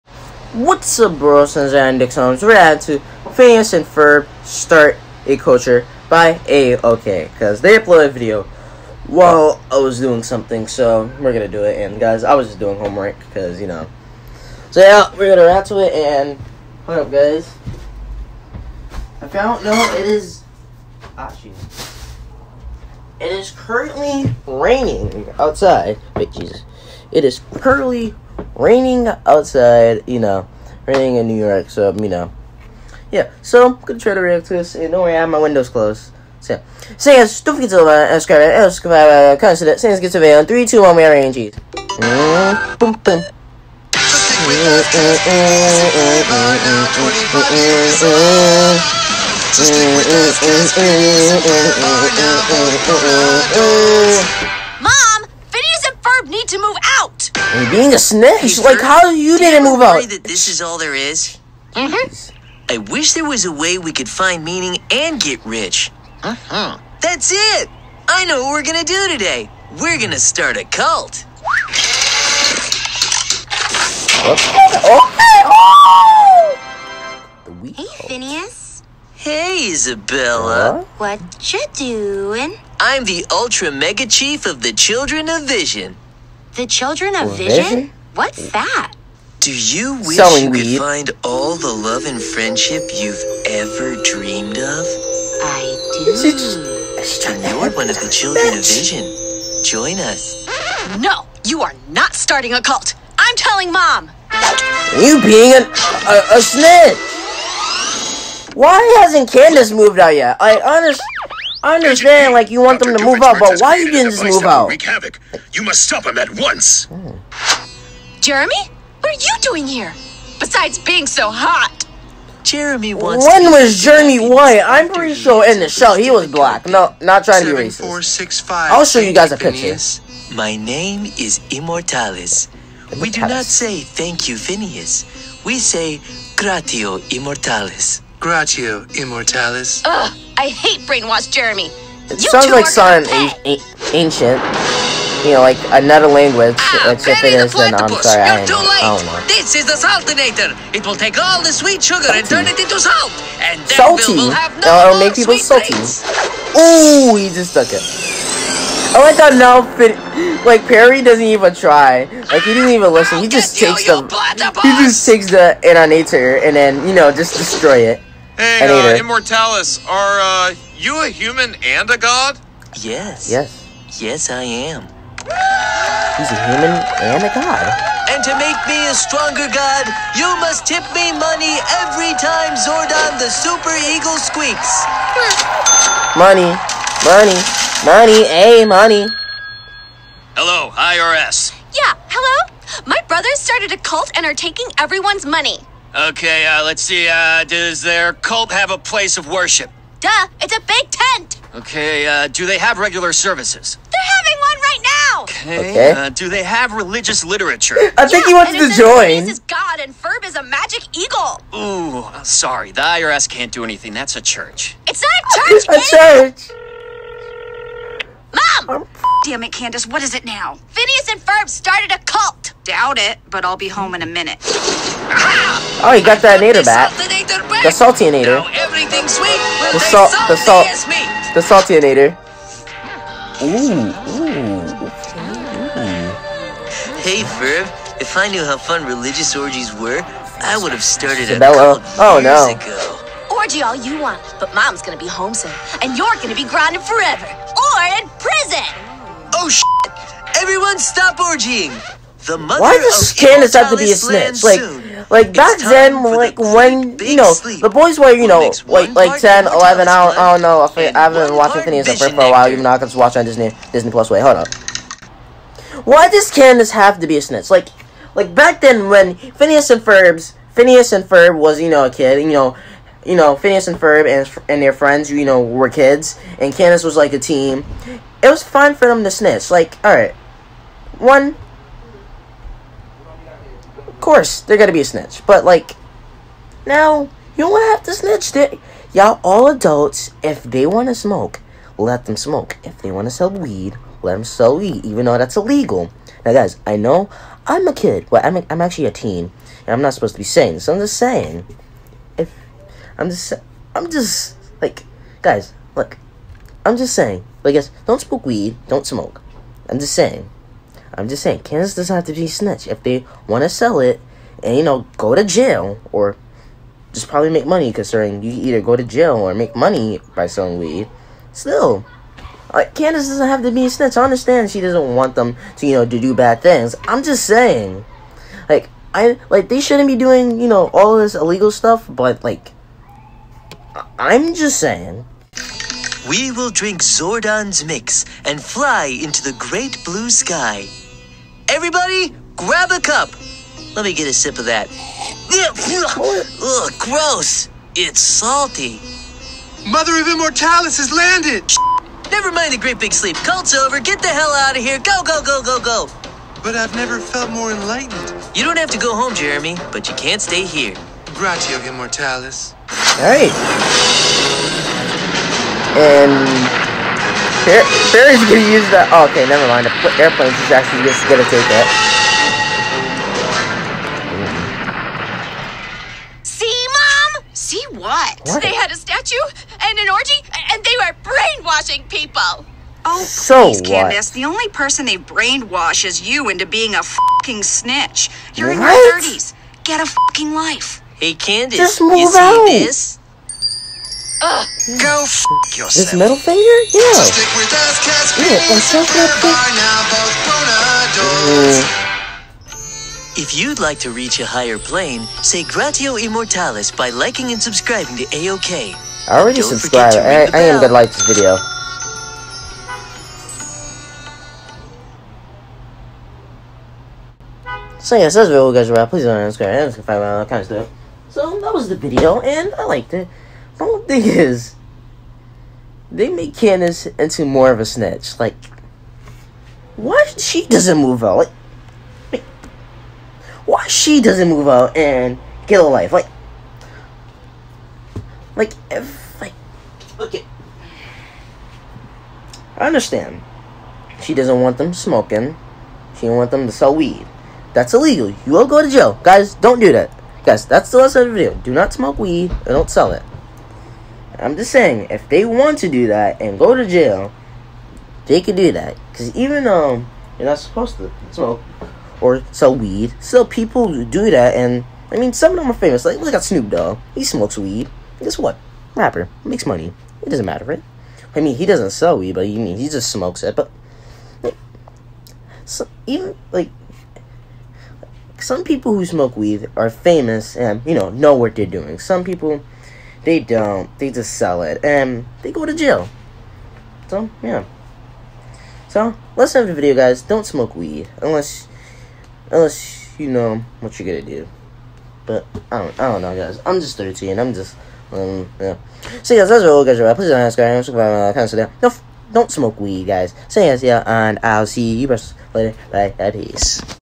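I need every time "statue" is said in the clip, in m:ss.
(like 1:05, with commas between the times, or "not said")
6:18.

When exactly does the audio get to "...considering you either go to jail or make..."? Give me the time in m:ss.
5:17.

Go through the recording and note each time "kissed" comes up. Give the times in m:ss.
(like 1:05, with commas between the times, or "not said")
not said.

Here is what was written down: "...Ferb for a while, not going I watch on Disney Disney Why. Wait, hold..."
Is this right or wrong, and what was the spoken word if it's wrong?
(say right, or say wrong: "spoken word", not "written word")
wrong: "Plus", not "Why".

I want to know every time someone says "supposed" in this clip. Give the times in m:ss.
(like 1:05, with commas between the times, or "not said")
4:59, 7:40.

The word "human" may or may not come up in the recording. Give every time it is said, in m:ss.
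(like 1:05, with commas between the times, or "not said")
2:51, 2:56.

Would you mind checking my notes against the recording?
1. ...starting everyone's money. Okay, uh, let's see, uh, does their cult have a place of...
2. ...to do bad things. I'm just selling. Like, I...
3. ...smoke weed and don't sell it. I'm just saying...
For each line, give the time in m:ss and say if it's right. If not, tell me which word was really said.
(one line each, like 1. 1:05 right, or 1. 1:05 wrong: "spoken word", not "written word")
1. 3:14 wrong: "taking", not "starting"
2. 5:25 wrong: "saying", not "selling"
3. 7:31 right.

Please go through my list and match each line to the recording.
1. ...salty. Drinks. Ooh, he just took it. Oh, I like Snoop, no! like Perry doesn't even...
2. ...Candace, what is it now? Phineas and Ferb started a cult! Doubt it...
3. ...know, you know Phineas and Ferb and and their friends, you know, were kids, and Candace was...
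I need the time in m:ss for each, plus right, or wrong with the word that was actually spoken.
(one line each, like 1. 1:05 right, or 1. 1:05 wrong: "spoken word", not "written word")
1. 2:35 wrong: "God", not "Snoop"
2. 3:39 right
3. 4:32 right.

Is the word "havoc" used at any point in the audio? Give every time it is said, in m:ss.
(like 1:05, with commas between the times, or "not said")
1:54.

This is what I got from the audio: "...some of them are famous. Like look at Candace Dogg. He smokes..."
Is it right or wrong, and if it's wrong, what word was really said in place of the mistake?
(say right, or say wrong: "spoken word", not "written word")
wrong: "Snoop", not "Candace".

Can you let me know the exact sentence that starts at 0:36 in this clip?
So, say not forget to like, uh, subscribe, and uh, subscribe.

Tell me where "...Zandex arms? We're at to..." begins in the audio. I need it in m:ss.
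0:01.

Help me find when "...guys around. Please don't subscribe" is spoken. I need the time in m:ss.
6:58.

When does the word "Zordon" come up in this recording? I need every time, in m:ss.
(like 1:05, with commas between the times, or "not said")
3:02, 5:36.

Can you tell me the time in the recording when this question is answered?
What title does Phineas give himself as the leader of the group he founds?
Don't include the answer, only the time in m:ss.
1:23.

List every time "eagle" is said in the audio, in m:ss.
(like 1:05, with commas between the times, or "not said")
3:03, 3:30.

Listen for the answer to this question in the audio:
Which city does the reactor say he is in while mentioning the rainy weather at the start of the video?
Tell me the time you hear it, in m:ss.
0:31.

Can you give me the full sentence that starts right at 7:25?
She don't want them to sell weed.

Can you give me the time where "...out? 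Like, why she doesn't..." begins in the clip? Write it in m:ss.
7:11.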